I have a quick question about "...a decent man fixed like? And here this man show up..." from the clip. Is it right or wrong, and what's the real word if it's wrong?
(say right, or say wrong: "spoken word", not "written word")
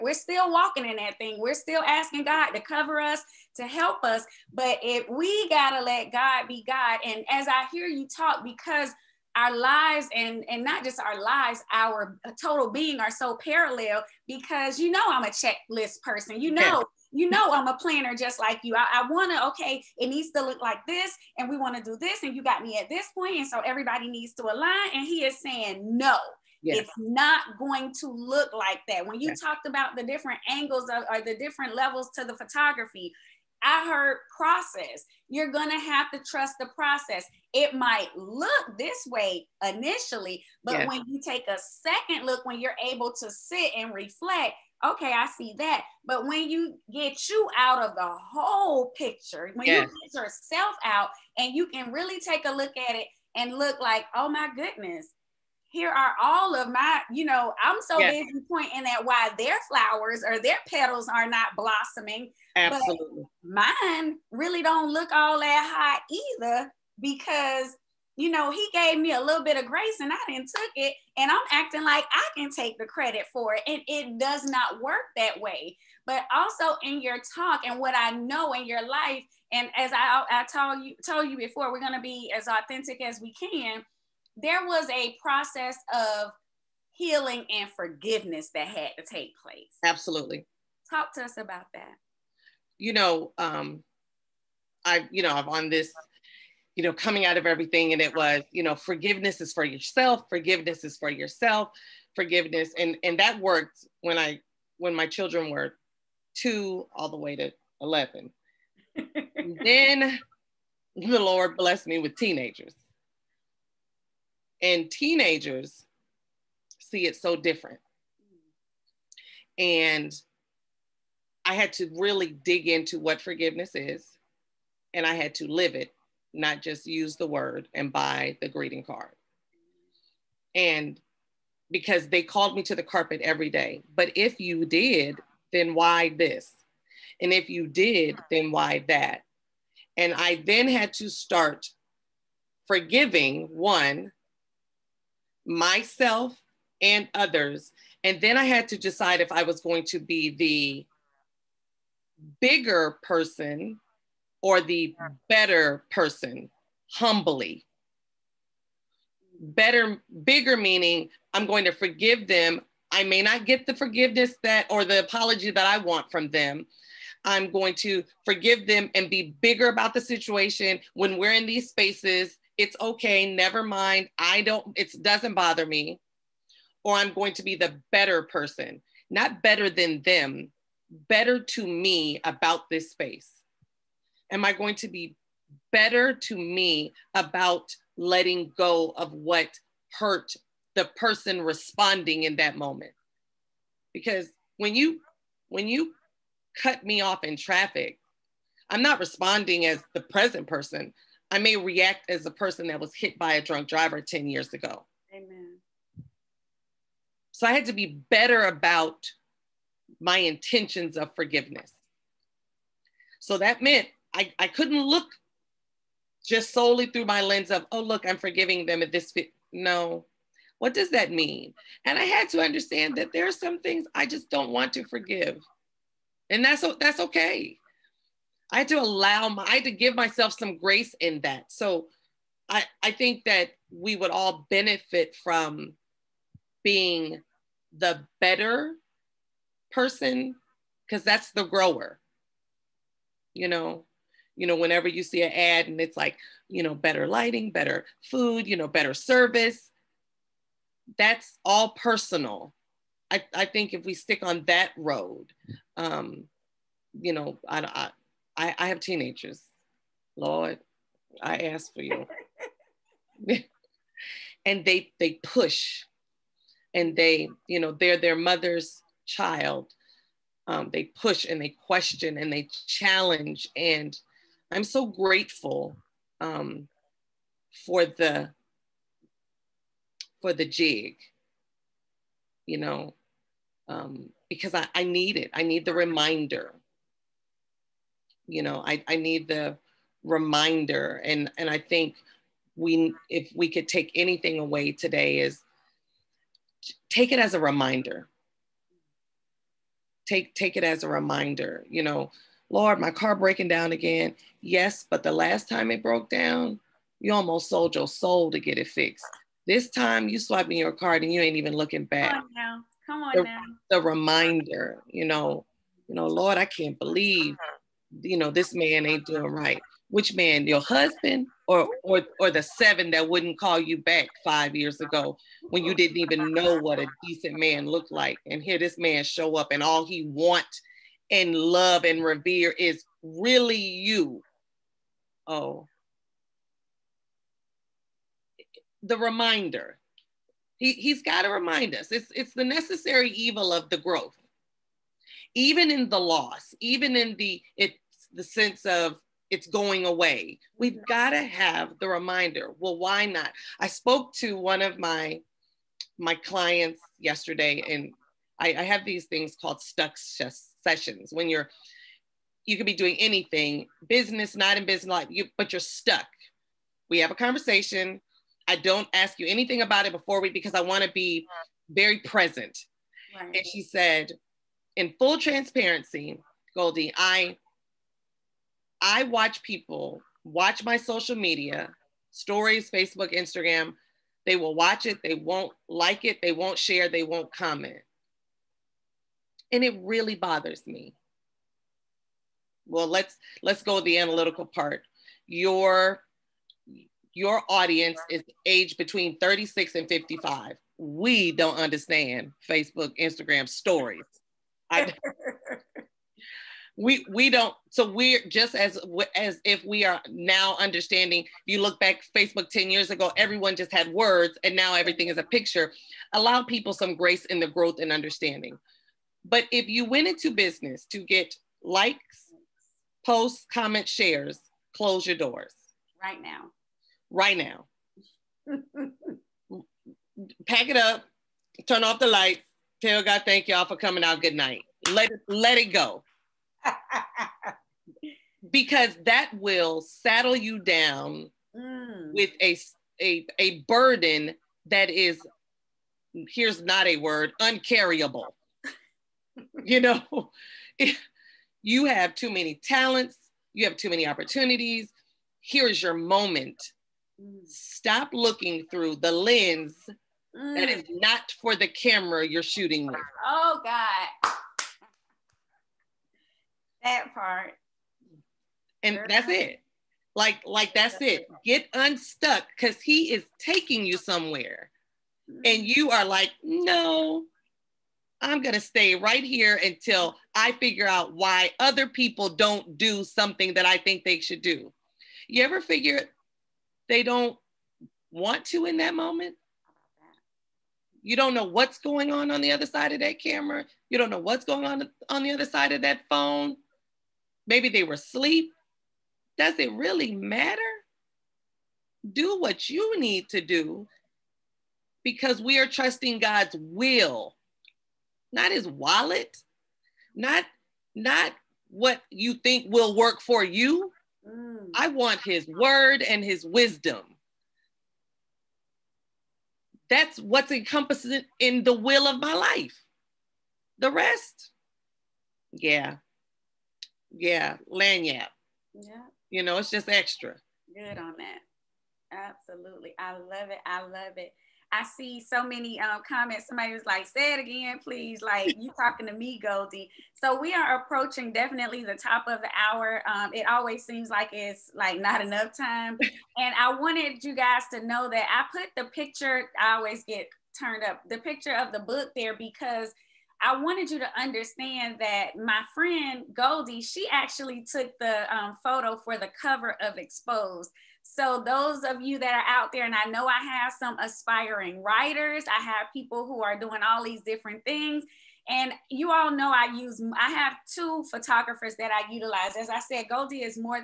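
wrong: "looked", not "fixed".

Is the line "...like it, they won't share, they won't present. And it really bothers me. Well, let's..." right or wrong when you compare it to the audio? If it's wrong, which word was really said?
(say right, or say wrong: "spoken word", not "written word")
wrong: "comment", not "present".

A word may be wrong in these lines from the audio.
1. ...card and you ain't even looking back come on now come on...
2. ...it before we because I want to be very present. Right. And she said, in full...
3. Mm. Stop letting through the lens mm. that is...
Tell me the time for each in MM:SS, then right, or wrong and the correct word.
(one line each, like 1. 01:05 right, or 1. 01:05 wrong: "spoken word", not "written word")
1. 05:10 right
2. 06:09 right
3. 07:37 wrong: "looking", not "letting".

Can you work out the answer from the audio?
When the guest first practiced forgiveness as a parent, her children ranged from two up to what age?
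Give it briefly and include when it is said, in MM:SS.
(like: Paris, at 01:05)
11, at 01:47.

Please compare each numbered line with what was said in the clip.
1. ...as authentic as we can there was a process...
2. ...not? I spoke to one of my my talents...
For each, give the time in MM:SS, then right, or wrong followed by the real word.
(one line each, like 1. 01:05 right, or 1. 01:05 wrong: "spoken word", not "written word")
1. 01:22 right
2. 05:53 wrong: "clients", not "talents".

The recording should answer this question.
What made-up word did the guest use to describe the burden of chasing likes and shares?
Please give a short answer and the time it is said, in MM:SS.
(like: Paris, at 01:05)
Uncarryable, at 07:27.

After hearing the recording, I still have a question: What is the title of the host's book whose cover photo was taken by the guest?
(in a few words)
Exposed.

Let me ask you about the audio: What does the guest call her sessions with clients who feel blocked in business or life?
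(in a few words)
Stuck sessions.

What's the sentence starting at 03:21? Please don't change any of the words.
I may react as a person that was hit by a drunk driver 10 years ago.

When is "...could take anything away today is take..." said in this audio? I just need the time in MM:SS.
04:53.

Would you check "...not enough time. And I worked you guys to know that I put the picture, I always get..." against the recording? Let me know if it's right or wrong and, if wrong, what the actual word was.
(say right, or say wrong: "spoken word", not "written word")
wrong: "wanted", not "worked".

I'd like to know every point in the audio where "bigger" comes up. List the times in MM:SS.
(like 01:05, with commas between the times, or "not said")
02:32, 02:40, 02:49.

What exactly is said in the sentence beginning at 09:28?
And you all know I use, I have two photographers that I utilize.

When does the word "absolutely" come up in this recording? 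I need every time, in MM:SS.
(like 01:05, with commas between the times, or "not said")
01:02, 01:29, 08:52.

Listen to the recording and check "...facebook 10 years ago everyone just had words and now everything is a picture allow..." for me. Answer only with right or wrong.
right.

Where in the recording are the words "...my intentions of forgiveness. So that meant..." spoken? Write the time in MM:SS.
03:29.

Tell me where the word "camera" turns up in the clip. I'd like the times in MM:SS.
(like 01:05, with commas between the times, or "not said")
07:41, 08:13.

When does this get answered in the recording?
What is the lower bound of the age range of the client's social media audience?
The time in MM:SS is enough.
06:39.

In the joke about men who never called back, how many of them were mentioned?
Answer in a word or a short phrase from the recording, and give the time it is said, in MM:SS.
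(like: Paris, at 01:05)
Seven, at 05:22.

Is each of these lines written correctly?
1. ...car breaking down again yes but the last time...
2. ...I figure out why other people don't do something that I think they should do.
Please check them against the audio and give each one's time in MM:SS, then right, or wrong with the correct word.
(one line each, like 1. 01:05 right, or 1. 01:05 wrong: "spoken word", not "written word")
1. 05:02 right
2. 08:00 right.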